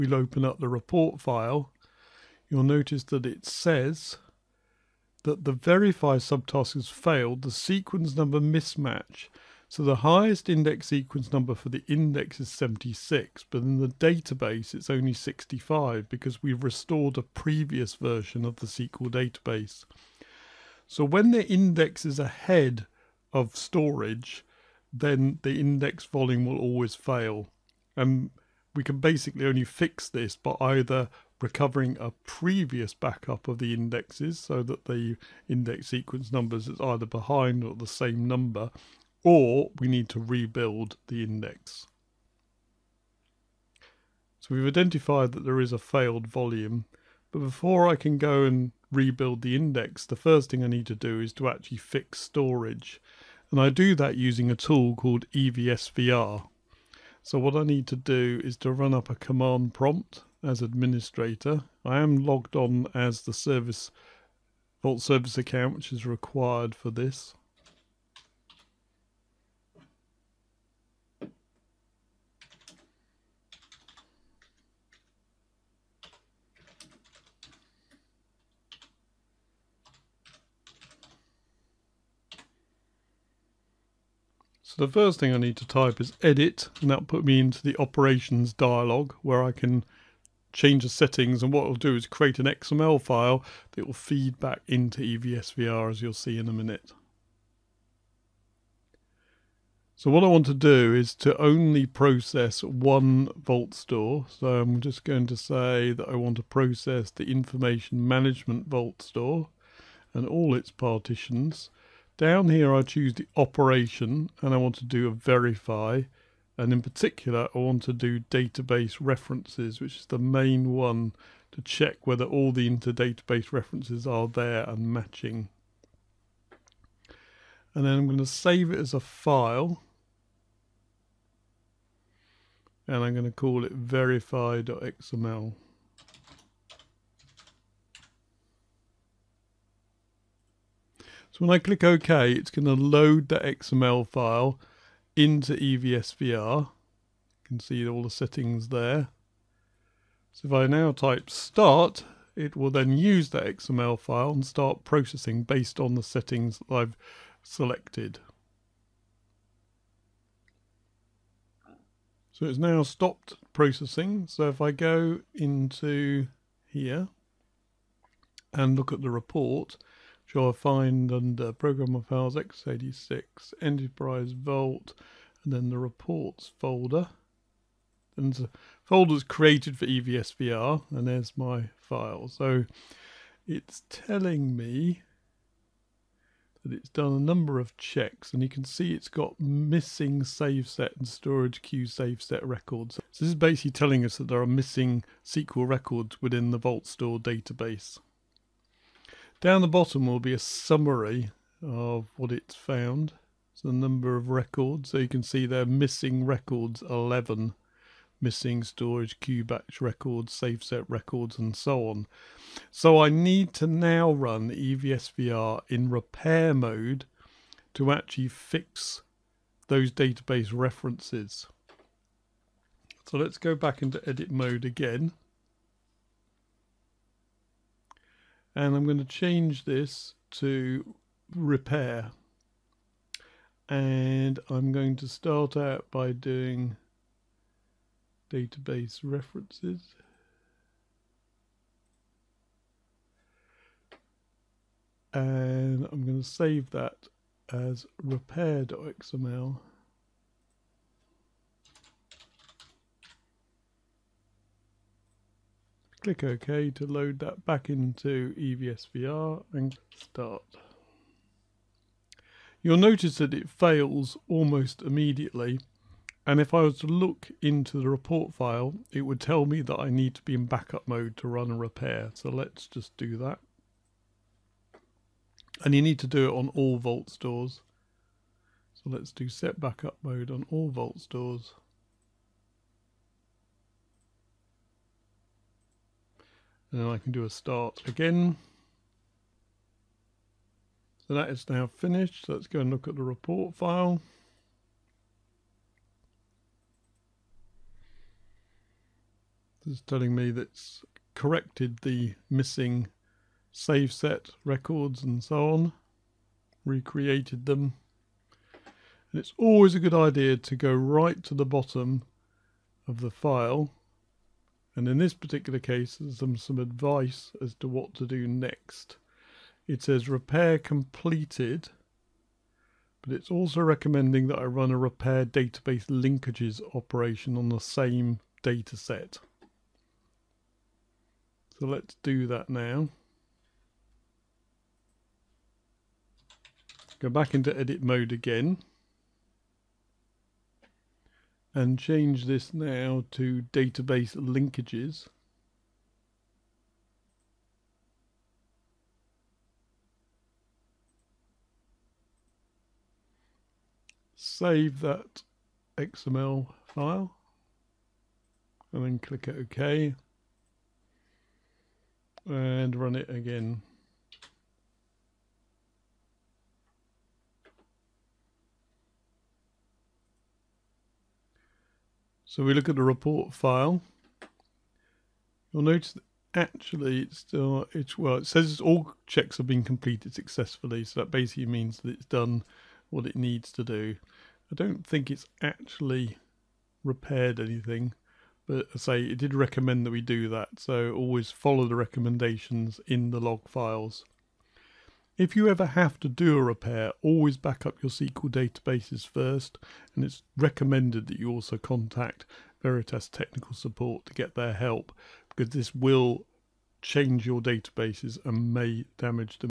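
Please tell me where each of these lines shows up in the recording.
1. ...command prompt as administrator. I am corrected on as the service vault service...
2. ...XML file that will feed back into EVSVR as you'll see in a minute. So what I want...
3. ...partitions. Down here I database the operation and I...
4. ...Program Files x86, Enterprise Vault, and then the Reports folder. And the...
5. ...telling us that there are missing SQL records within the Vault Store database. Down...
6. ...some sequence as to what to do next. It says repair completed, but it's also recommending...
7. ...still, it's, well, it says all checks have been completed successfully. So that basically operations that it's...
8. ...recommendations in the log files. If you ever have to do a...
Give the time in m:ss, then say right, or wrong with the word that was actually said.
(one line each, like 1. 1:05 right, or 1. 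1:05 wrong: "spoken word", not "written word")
1. 0:59 wrong: "logged", not "corrected"
2. 1:32 right
3. 1:50 wrong: "choose", not "database"
4. 2:51 right
5. 3:13 right
6. 5:16 wrong: "advice", not "sequence"
7. 6:17 wrong: "means", not "operations"
8. 6:31 right.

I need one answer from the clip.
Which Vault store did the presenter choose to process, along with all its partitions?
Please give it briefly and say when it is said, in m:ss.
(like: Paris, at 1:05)
Information management Vault store, at 1:47.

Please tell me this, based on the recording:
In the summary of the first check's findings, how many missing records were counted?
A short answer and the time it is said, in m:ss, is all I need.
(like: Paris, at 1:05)
11, at 3:26.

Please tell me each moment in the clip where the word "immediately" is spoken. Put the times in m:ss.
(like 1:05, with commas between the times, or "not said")
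4:24.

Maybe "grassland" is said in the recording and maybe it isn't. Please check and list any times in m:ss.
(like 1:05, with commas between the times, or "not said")
not said.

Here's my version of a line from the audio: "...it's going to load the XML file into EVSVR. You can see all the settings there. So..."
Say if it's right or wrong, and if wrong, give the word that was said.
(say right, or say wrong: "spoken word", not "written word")
right.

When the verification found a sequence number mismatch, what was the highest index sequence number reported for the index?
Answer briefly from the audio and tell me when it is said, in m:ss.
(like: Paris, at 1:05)
76, at 0:12.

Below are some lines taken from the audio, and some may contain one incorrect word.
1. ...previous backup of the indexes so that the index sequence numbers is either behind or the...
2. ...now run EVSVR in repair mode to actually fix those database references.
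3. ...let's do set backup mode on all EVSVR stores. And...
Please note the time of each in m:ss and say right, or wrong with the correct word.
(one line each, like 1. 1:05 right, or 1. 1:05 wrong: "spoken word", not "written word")
1. 0:32 right
2. 3:33 right
3. 4:38 wrong: "Vault", not "EVSVR".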